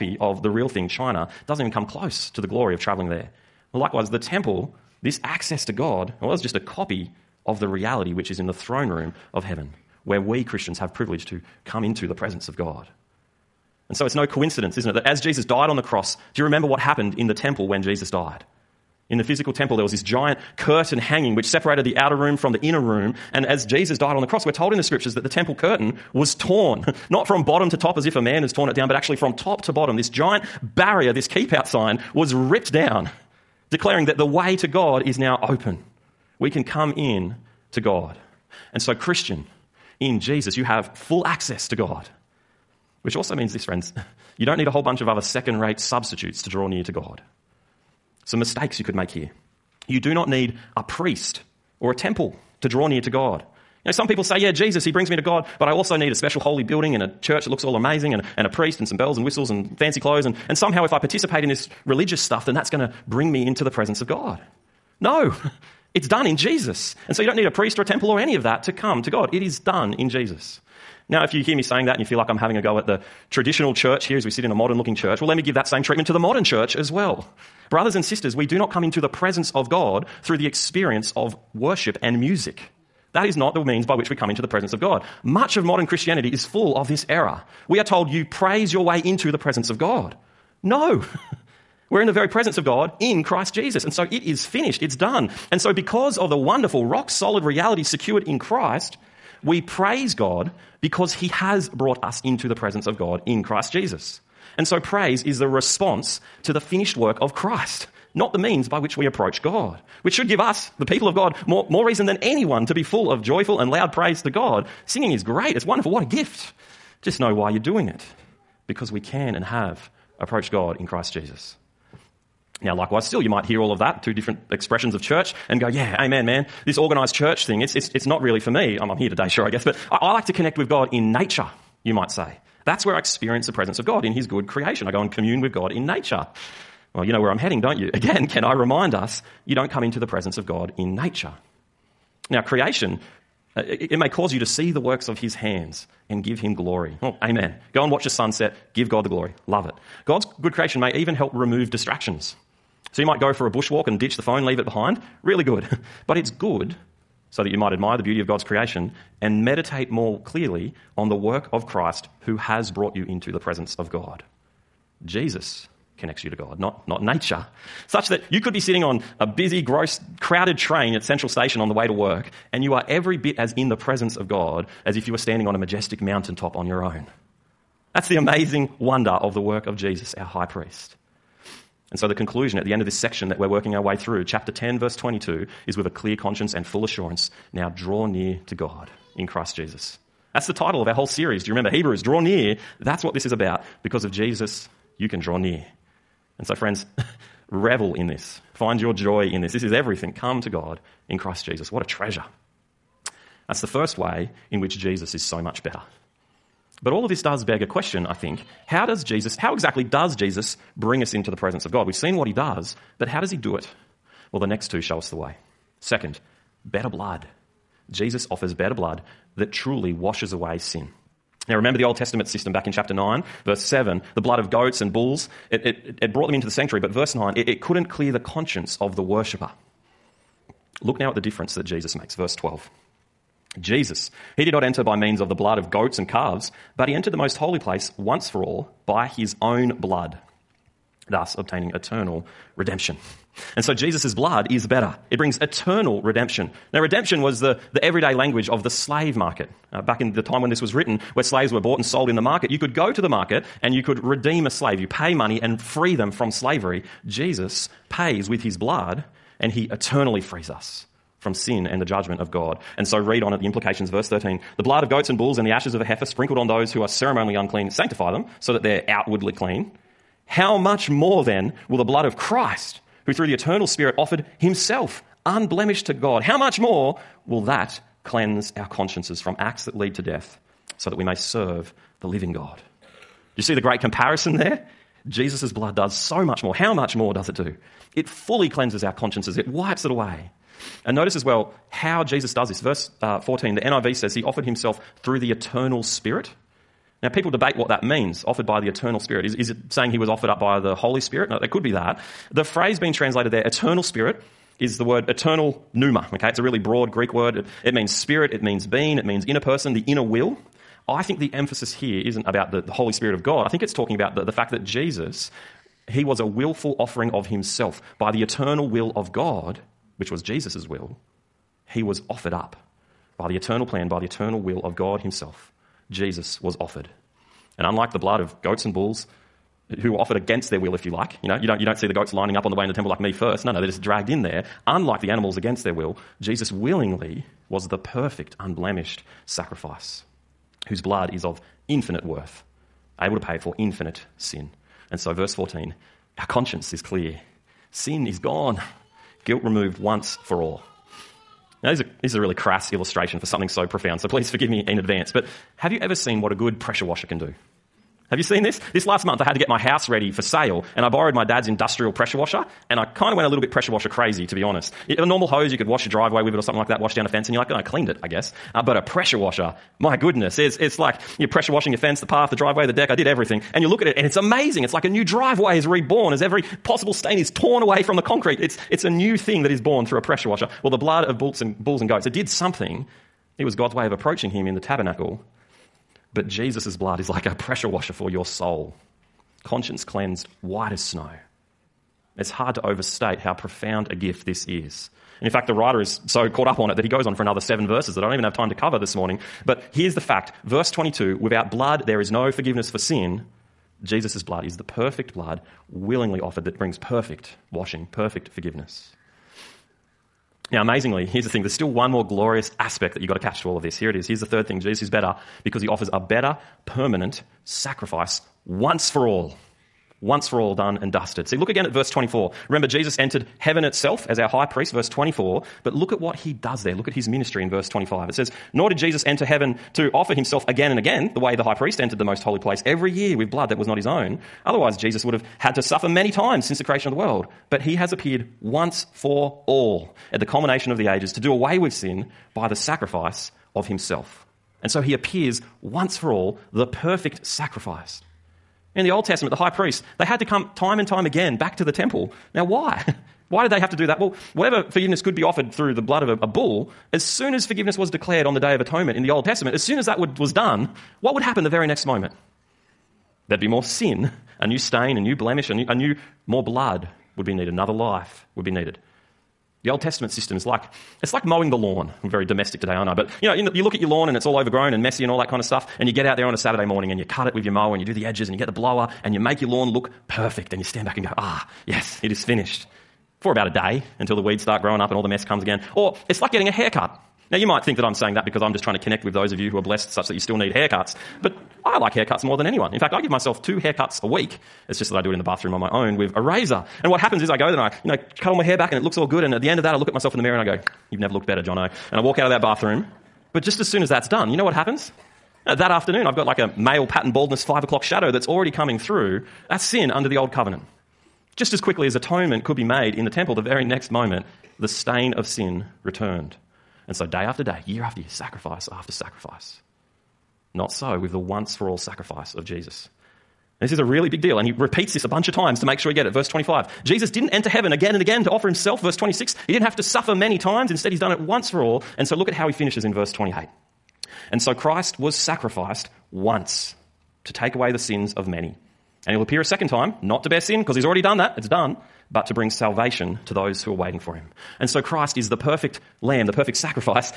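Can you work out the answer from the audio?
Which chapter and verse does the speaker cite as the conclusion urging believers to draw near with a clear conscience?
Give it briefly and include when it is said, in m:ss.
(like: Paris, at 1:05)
Chapter 10, verse 22, at 3:04.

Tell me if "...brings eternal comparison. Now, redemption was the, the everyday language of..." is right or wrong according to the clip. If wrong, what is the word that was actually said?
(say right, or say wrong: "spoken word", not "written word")
wrong: "redemption", not "comparison".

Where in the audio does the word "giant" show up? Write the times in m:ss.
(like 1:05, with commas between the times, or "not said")
0:20, 0:30.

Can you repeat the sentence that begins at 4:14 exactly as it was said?
You pay money and free them from slavery.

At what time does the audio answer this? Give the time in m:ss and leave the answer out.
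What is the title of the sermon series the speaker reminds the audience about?
3:11.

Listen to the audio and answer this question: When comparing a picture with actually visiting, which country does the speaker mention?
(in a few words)
China.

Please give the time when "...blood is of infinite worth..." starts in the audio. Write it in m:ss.
5:40.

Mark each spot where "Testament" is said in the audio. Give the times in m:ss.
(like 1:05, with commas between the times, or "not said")
3:41, 7:29, 7:39, 7:49.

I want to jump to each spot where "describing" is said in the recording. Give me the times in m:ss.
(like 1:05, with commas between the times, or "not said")
not said.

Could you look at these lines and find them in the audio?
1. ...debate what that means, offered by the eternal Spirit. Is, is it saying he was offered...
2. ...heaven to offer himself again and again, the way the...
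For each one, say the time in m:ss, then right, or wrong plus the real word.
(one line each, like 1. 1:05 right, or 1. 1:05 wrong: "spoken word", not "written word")
1. 4:57 right
2. 7:09 right.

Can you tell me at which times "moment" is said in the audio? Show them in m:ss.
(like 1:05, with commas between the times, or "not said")
7:41, 8:33.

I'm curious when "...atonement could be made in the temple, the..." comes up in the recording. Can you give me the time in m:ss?
8:31.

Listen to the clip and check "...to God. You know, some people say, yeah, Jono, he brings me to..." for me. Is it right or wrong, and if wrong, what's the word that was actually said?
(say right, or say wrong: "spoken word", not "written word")
wrong: "Jesus", not "Jono".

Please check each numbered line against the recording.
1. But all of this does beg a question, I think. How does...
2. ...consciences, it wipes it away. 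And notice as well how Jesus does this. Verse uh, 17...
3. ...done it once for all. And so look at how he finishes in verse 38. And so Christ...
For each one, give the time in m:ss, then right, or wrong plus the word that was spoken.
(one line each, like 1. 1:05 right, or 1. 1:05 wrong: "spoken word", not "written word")
1. 3:26 right
2. 4:48 wrong: "14", not "17"
3. 8:50 wrong: "28", not "38".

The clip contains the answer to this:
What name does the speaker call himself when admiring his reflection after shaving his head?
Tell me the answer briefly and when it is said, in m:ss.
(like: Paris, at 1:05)
Jono, at 8:21.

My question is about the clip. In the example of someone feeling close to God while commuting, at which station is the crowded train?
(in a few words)
Central Station.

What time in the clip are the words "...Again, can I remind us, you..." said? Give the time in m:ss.
2:17.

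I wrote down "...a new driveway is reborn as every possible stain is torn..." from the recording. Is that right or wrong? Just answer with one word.
right.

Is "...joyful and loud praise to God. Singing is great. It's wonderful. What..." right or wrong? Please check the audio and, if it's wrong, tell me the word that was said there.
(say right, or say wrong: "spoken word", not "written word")
right.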